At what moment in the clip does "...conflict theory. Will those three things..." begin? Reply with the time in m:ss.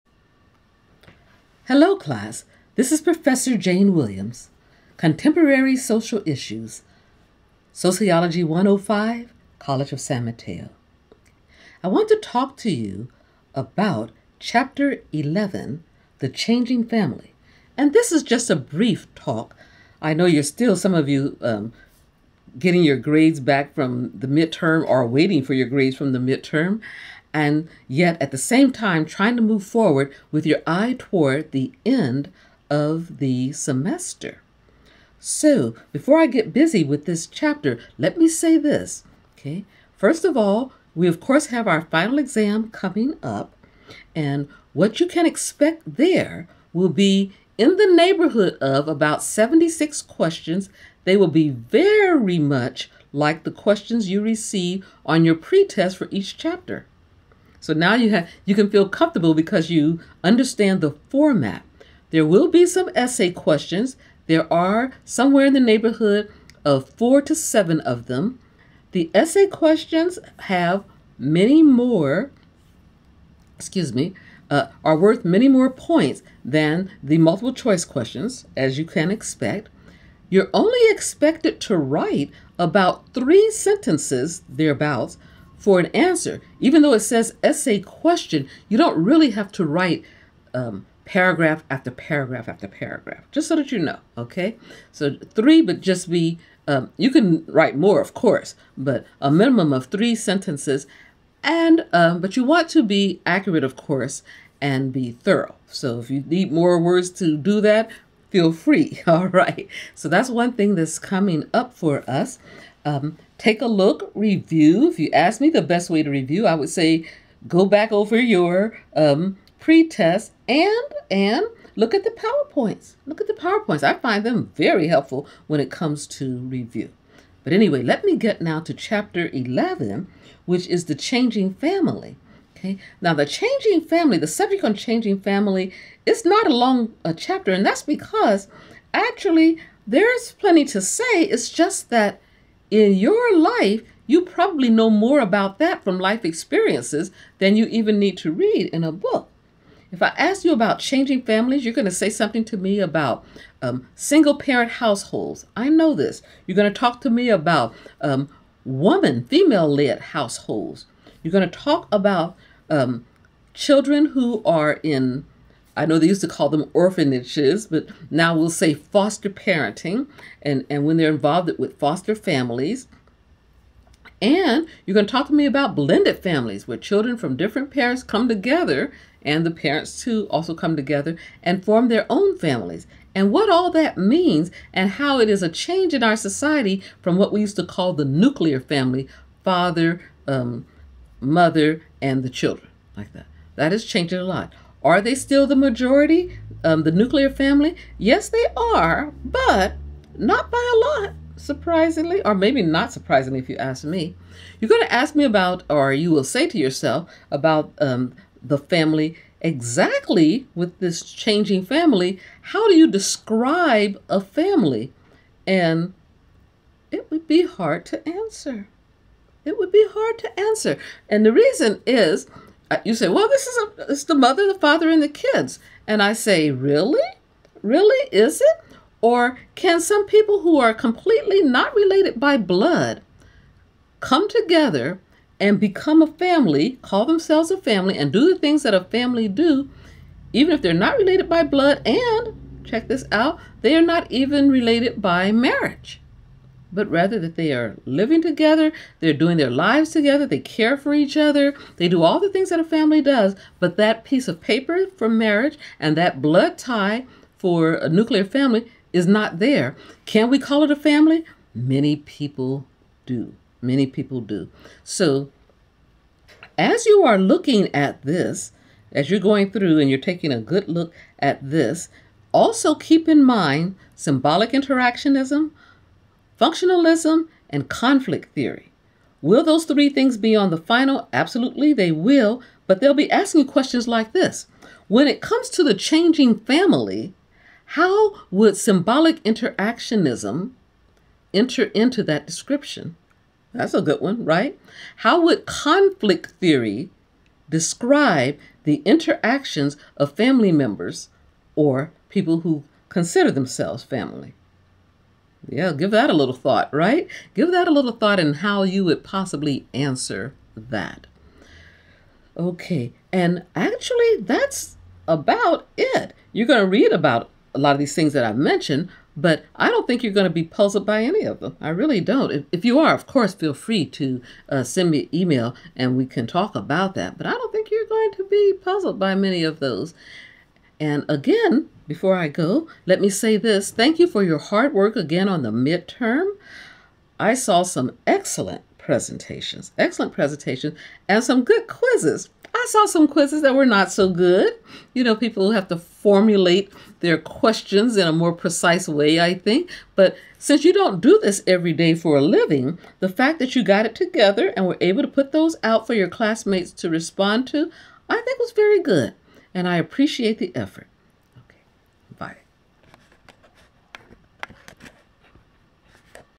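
4:37.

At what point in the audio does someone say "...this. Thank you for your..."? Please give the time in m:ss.
5:33.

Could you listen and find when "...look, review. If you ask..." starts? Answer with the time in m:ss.
1:53.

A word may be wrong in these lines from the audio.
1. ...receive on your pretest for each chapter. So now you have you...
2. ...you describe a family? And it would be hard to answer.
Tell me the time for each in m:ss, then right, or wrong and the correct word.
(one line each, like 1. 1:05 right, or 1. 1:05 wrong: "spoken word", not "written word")
1. 0:54 right
2. 3:32 right.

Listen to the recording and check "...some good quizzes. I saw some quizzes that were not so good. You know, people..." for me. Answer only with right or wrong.
right.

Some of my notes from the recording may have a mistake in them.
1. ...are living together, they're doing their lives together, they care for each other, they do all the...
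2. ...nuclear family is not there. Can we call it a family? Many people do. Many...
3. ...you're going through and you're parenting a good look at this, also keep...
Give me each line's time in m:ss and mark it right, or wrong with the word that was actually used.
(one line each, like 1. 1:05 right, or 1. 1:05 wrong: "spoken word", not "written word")
1. 4:07 right
2. 4:17 right
3. 4:29 wrong: "taking", not "parenting".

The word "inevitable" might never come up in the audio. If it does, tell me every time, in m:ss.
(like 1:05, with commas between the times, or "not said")
not said.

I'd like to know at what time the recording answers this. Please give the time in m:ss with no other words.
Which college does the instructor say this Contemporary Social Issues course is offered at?
0:09.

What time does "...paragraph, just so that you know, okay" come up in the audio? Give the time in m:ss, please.
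1:32.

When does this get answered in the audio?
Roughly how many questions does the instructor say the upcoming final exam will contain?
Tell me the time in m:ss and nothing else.
0:49.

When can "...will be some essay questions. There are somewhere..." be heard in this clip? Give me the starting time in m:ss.
1:02.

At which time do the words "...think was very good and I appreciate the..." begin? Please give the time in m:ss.
5:58.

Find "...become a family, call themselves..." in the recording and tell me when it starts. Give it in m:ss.
3:55.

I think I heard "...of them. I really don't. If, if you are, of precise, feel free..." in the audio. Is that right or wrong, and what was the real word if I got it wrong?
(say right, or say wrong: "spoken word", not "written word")
wrong: "course", not "precise".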